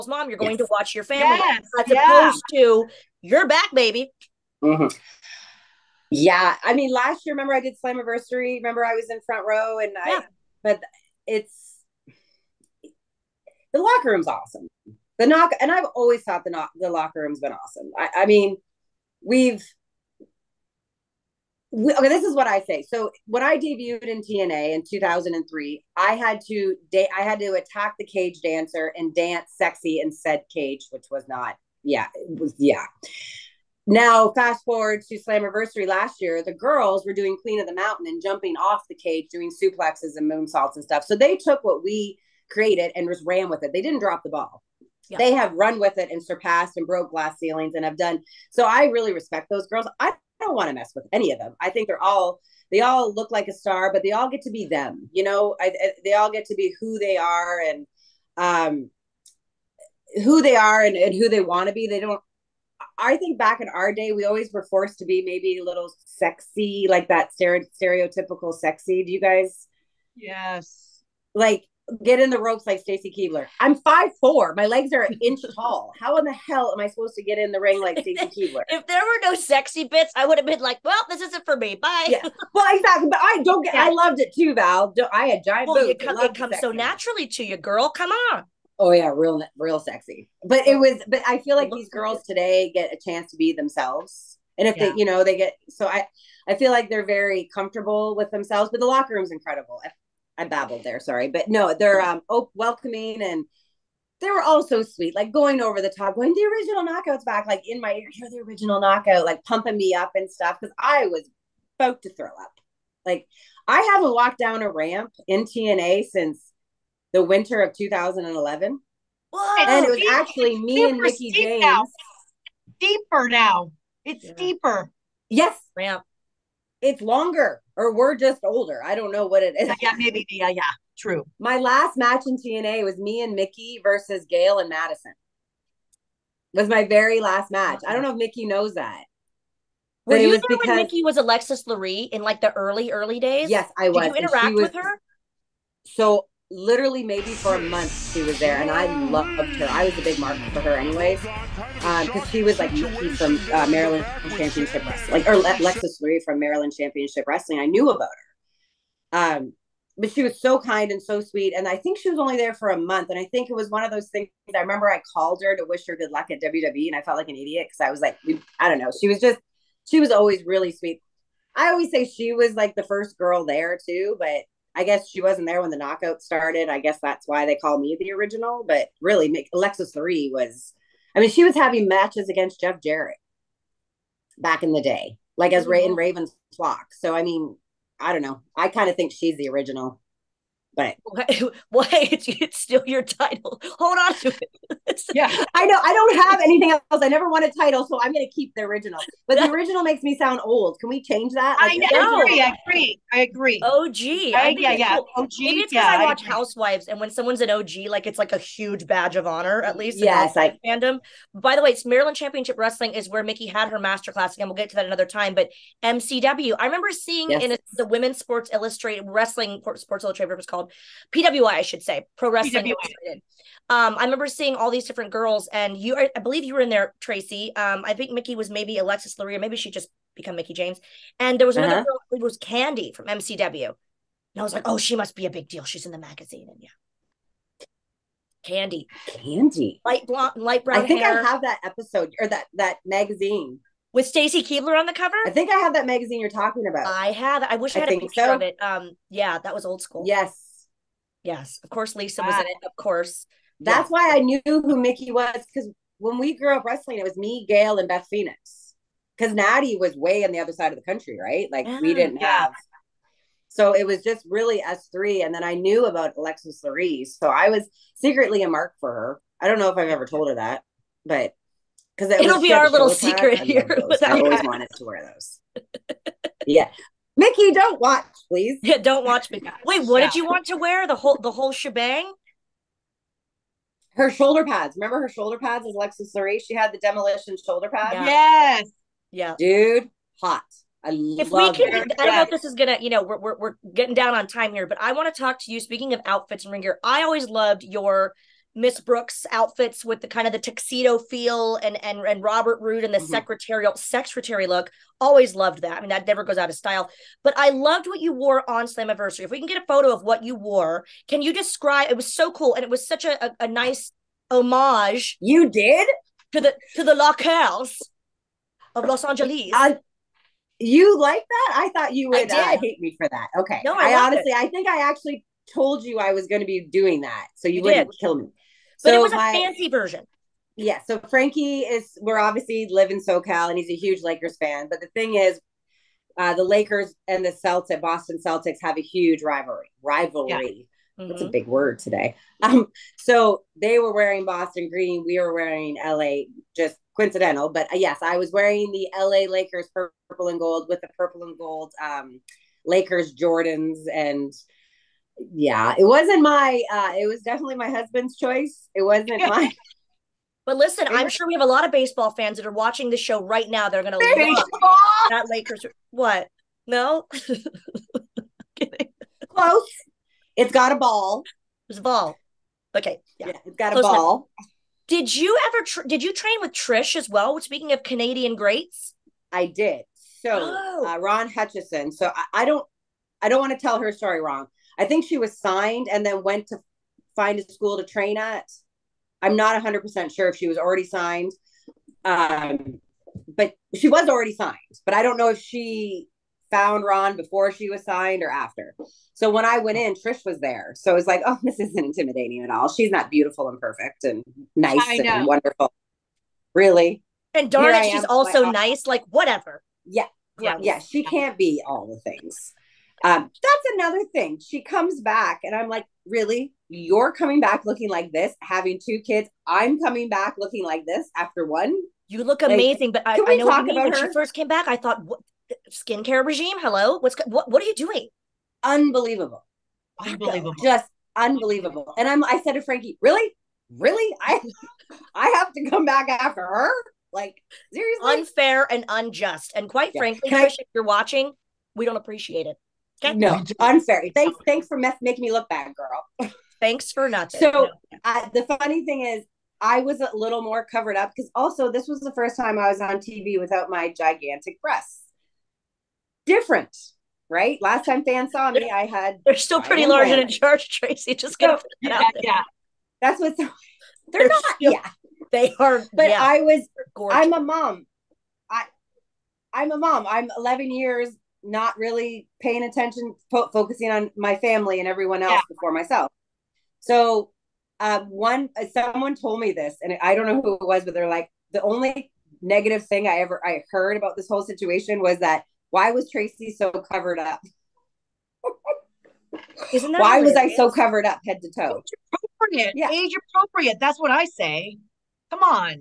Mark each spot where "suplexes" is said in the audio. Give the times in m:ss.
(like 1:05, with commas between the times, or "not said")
0:39.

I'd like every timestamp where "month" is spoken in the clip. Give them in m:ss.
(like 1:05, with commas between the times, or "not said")
2:27, 2:42.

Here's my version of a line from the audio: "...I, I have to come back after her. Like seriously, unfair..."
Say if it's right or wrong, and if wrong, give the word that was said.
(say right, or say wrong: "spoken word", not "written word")
right.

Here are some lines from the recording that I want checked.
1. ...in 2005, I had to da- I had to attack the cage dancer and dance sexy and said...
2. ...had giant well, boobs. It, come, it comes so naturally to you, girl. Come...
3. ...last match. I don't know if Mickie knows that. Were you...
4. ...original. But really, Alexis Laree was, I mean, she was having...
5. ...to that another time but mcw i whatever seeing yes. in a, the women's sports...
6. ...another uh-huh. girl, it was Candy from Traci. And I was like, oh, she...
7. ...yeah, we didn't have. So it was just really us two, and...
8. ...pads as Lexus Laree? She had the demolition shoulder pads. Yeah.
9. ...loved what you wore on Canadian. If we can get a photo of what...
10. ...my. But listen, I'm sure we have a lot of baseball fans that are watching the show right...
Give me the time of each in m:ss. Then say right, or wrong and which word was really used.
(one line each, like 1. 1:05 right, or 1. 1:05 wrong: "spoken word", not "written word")
1. 0:24 wrong: "2003", not "2005"
2. 1:25 right
3. 2:17 right
4. 2:58 right
5. 3:34 wrong: "remember", not "whatever"
6. 3:51 wrong: "MCW", not "Traci"
7. 4:21 wrong: "three", not "two"
8. 4:45 right
9. 5:07 wrong: "Slammiversary", not "Canadian"
10. 5:59 right.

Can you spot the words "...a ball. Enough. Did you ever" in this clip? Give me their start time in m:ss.
6:13.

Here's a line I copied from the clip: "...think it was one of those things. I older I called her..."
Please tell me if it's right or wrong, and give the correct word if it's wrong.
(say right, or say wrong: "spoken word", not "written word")
wrong: "remember", not "older".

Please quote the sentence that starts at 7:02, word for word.
You look amazing, but I, I know what you mean.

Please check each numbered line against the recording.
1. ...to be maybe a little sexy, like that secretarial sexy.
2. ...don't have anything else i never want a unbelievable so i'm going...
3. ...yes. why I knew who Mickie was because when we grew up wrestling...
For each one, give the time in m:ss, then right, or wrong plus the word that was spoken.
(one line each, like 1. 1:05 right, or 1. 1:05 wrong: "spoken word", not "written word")
1. 1:04 wrong: "stereotypical", not "secretarial"
2. 3:15 wrong: "title", not "unbelievable"
3. 4:13 right.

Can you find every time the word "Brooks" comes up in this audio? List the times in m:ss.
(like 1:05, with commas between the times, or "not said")
4:58.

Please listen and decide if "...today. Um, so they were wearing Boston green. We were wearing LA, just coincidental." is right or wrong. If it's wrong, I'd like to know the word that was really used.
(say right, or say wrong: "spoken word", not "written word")
right.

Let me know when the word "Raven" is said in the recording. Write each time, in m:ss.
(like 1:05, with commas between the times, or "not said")
3:05.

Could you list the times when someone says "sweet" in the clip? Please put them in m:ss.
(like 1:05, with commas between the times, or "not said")
1:44, 2:41, 2:50.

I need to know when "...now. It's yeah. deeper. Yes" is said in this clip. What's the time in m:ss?
2:03.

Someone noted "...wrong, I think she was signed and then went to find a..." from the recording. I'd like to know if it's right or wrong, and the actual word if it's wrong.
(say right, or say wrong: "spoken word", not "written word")
right.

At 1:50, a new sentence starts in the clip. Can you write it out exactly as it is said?
Cause I was about to throw up.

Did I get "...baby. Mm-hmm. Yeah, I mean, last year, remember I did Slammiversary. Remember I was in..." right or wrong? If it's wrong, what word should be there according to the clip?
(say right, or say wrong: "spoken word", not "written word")
right.